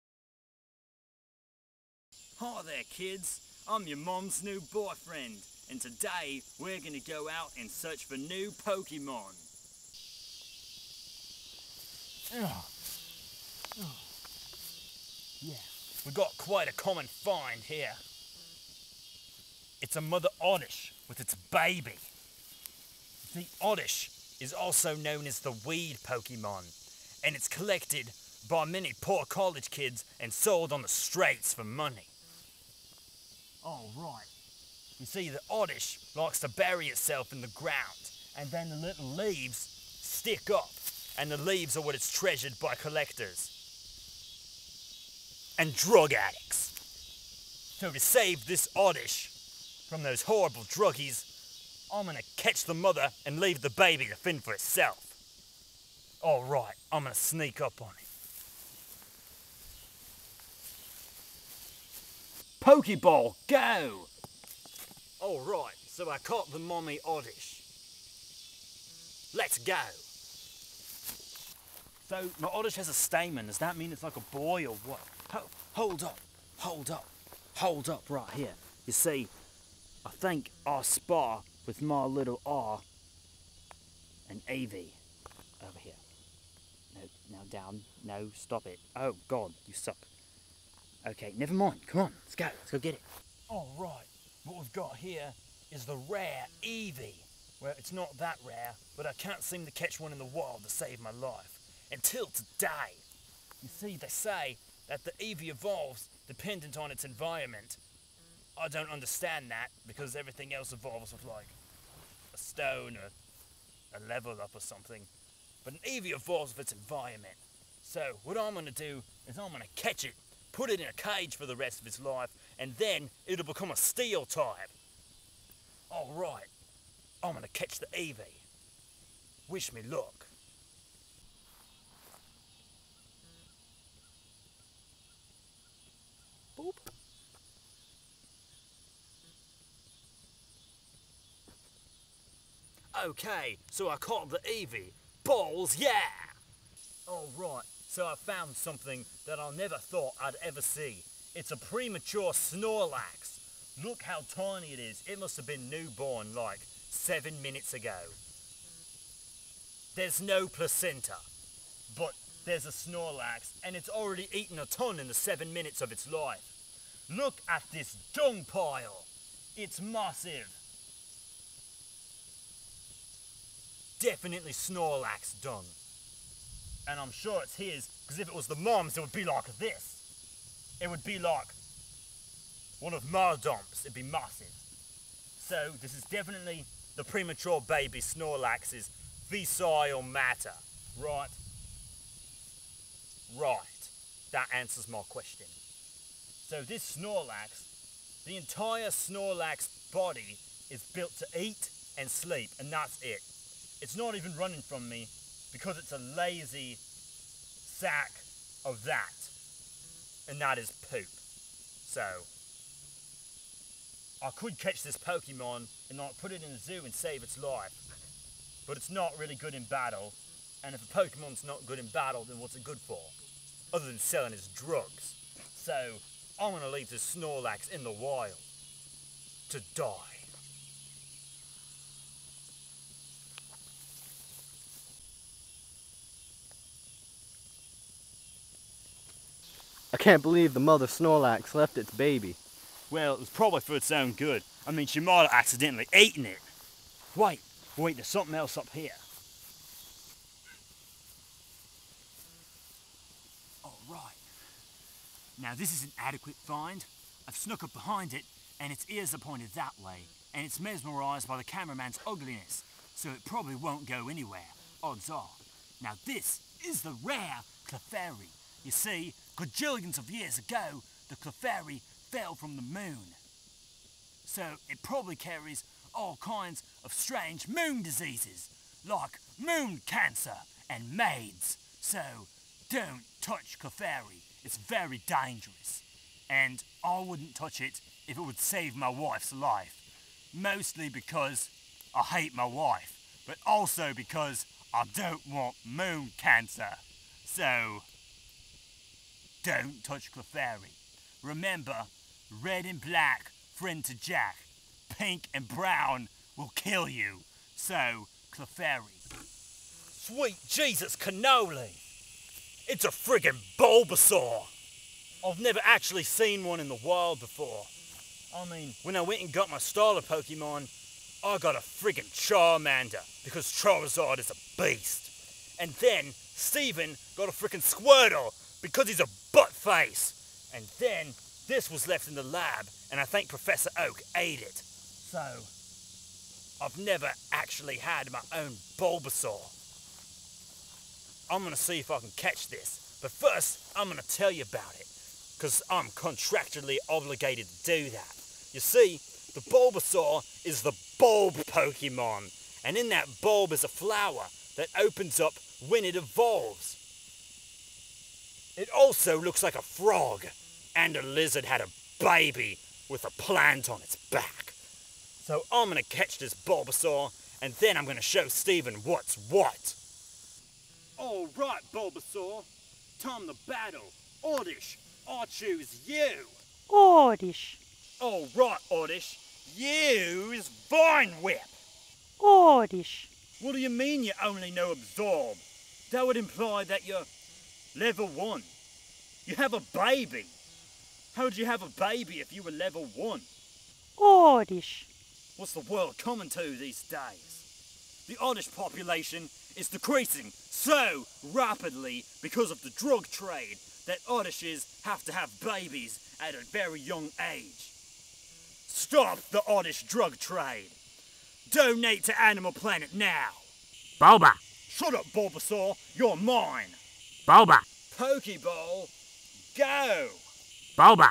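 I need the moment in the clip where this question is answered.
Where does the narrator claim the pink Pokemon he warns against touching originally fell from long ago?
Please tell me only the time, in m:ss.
4:32.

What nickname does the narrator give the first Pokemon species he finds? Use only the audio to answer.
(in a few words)
The weed Pokemon.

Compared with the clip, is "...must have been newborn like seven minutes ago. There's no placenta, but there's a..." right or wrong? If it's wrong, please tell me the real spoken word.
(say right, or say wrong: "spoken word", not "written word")
right.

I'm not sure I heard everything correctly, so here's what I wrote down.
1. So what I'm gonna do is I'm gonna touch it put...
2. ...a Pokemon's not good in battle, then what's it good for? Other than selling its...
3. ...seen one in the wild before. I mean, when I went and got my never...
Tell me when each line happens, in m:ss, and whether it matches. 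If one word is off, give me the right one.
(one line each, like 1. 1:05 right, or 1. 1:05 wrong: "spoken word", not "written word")
1. 1:57 wrong: "catch", not "touch"
2. 3:40 right
3. 5:16 wrong: "starter", not "never".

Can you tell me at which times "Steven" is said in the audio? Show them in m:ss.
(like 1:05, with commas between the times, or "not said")
5:26, 6:08.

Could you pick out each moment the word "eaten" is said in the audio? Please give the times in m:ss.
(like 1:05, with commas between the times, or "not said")
2:44, 4:05.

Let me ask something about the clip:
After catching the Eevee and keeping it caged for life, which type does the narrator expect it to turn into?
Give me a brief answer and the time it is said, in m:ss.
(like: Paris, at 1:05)
Steel type, at 2:03.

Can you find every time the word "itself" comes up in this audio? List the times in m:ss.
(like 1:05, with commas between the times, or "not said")
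0:36, 0:54.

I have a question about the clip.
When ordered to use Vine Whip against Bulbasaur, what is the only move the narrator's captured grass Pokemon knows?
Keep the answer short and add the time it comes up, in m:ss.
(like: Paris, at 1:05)
Absorb, at 6:24.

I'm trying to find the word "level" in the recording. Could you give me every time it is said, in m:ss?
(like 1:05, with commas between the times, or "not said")
1:54, 6:27, 6:32.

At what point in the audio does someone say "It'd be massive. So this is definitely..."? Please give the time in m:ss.
3:03.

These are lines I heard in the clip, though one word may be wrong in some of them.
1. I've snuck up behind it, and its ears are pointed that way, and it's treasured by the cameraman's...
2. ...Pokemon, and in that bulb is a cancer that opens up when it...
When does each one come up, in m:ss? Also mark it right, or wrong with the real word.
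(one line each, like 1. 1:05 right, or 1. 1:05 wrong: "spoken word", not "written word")
1. 4:17 wrong: "mesmerised", not "treasured"
2. 5:51 wrong: "flower", not "cancer".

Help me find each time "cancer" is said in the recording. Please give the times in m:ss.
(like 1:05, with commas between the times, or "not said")
4:39, 4:56.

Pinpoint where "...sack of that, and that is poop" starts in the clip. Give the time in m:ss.
3:26.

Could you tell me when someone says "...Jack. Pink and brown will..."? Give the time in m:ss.
5:03.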